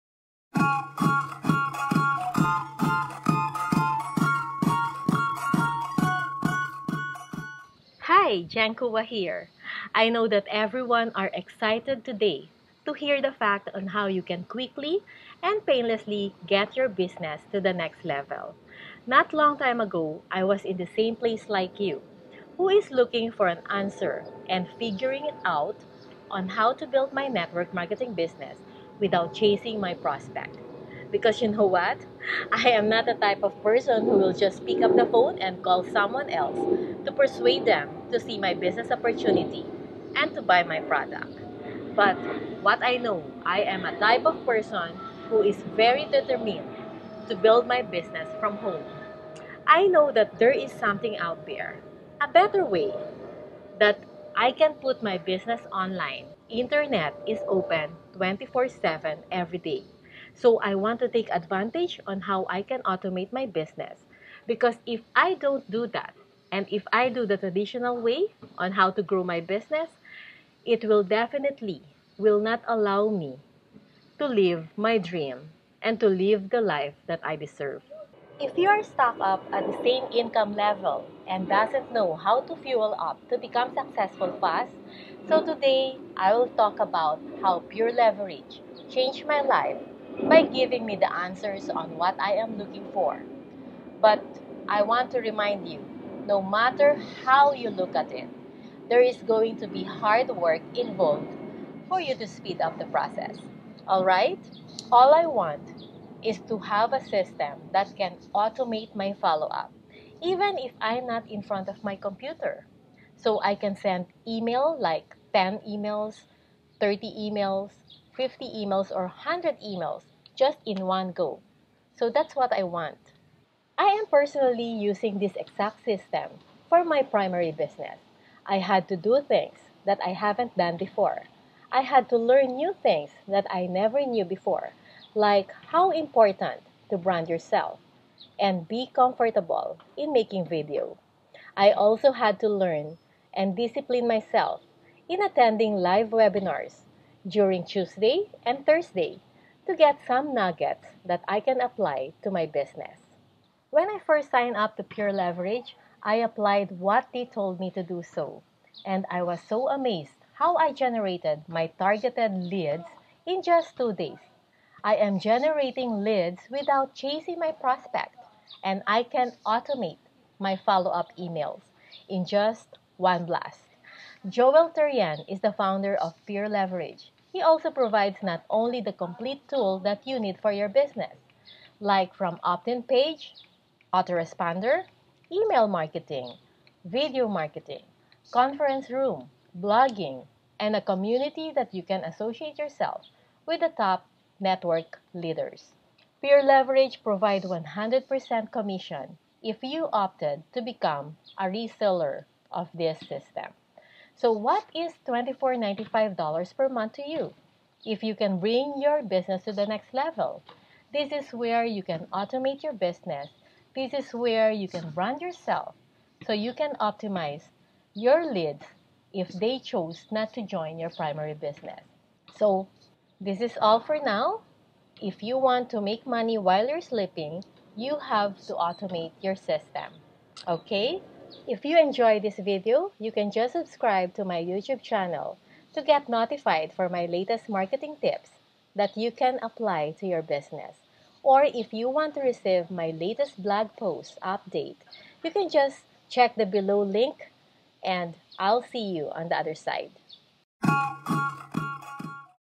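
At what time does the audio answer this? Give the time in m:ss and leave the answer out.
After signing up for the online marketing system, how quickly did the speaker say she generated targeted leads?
2:43.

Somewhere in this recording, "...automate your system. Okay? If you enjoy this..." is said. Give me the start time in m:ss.
3:48.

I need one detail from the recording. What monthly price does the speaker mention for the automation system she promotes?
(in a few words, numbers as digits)
$24.95.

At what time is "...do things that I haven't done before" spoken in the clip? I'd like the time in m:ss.
2:08.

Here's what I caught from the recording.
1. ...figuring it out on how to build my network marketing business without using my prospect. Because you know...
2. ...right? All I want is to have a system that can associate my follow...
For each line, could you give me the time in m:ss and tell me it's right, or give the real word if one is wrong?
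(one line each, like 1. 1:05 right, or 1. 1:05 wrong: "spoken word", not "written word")
1. 0:24 wrong: "chasing", not "using"
2. 1:44 wrong: "automate", not "associate".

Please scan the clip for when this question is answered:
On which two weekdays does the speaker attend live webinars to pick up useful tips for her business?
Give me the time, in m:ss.
2:27.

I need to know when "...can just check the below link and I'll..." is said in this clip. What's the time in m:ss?
4:05.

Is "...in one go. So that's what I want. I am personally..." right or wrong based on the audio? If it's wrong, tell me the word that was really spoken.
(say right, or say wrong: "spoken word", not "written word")
right.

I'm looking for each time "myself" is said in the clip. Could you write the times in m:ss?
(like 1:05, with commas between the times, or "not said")
2:24.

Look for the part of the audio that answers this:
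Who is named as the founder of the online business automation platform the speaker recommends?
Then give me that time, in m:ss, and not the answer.
2:54.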